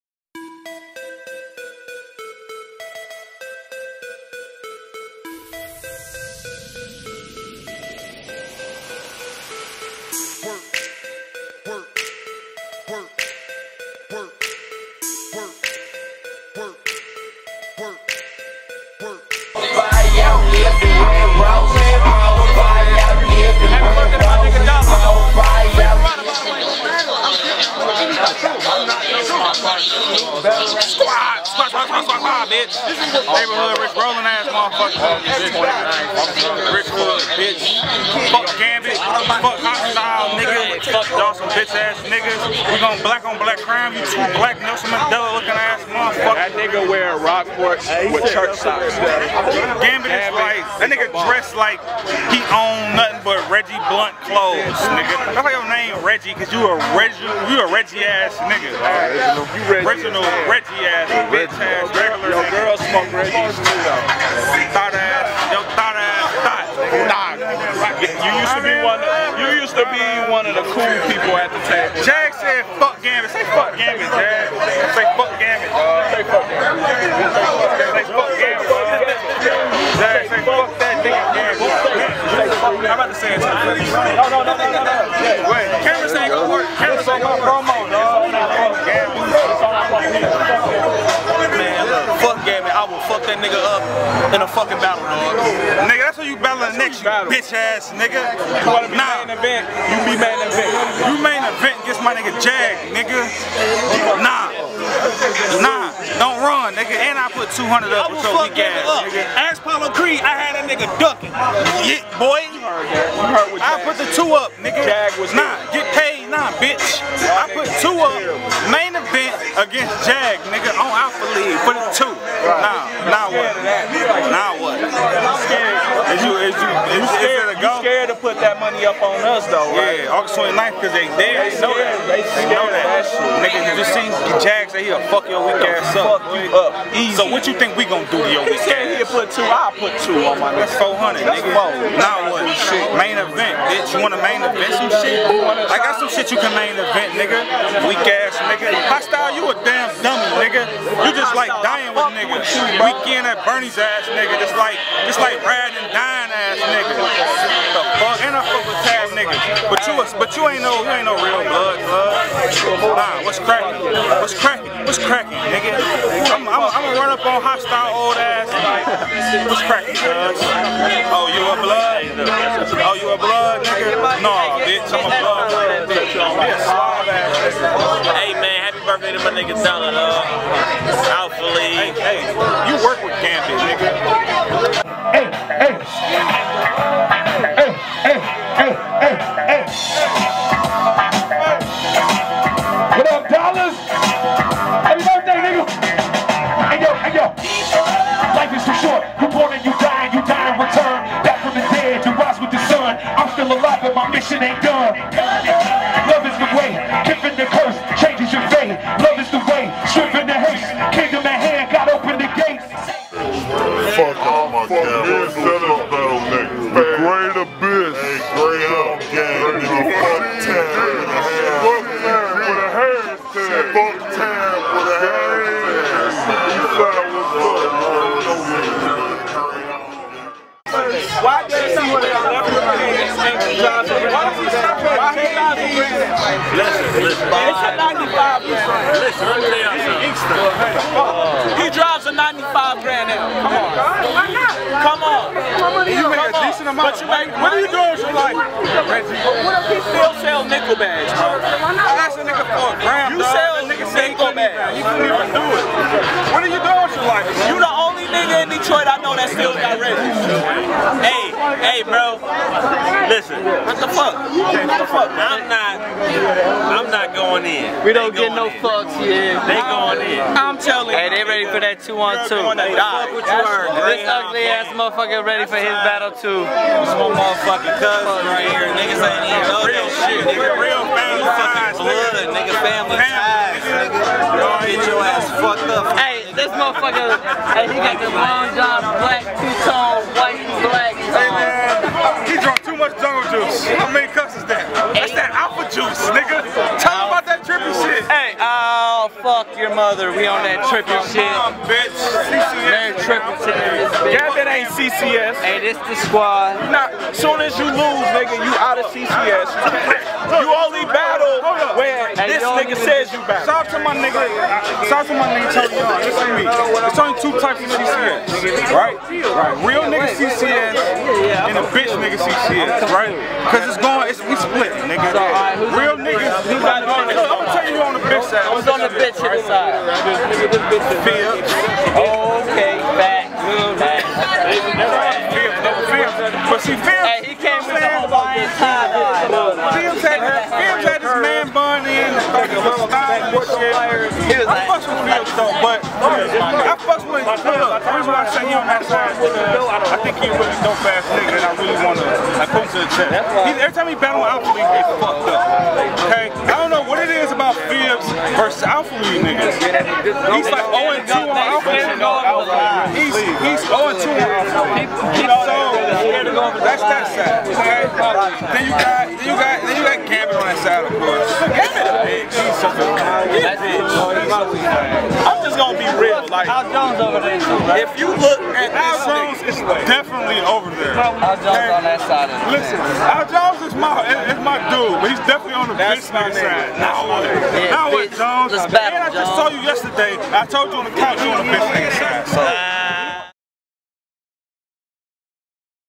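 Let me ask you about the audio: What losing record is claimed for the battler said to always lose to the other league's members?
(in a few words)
0-2.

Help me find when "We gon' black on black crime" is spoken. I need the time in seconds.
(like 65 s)
42 s.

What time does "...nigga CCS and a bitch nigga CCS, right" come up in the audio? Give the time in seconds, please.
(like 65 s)
319 s.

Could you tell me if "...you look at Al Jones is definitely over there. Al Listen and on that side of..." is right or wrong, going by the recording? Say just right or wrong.
wrong.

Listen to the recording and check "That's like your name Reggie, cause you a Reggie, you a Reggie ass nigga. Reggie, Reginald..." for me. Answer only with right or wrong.
right.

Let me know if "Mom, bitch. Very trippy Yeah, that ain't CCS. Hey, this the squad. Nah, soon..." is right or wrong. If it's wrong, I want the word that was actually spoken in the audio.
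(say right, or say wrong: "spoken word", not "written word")
right.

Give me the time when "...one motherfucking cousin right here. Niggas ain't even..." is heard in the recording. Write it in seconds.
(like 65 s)
276 s.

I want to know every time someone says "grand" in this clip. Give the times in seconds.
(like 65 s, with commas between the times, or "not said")
238 s, 242 s.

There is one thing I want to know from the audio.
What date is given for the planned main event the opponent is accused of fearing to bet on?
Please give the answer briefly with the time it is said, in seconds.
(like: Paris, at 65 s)
August 29th, at 130 s.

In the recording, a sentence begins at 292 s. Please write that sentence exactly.
He drunk too much jungle juice.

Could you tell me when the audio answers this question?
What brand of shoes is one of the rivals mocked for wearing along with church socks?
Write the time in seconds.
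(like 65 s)
47 s.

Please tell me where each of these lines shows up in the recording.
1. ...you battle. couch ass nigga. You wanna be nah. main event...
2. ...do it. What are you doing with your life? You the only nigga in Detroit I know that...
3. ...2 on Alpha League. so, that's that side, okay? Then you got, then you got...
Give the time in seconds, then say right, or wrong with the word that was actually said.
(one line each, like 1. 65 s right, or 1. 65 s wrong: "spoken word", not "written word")
1. 96 s wrong: "bitch", not "couch"
2. 255 s right
3. 363 s right.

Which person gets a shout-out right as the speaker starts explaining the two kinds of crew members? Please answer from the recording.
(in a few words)
Terry Young.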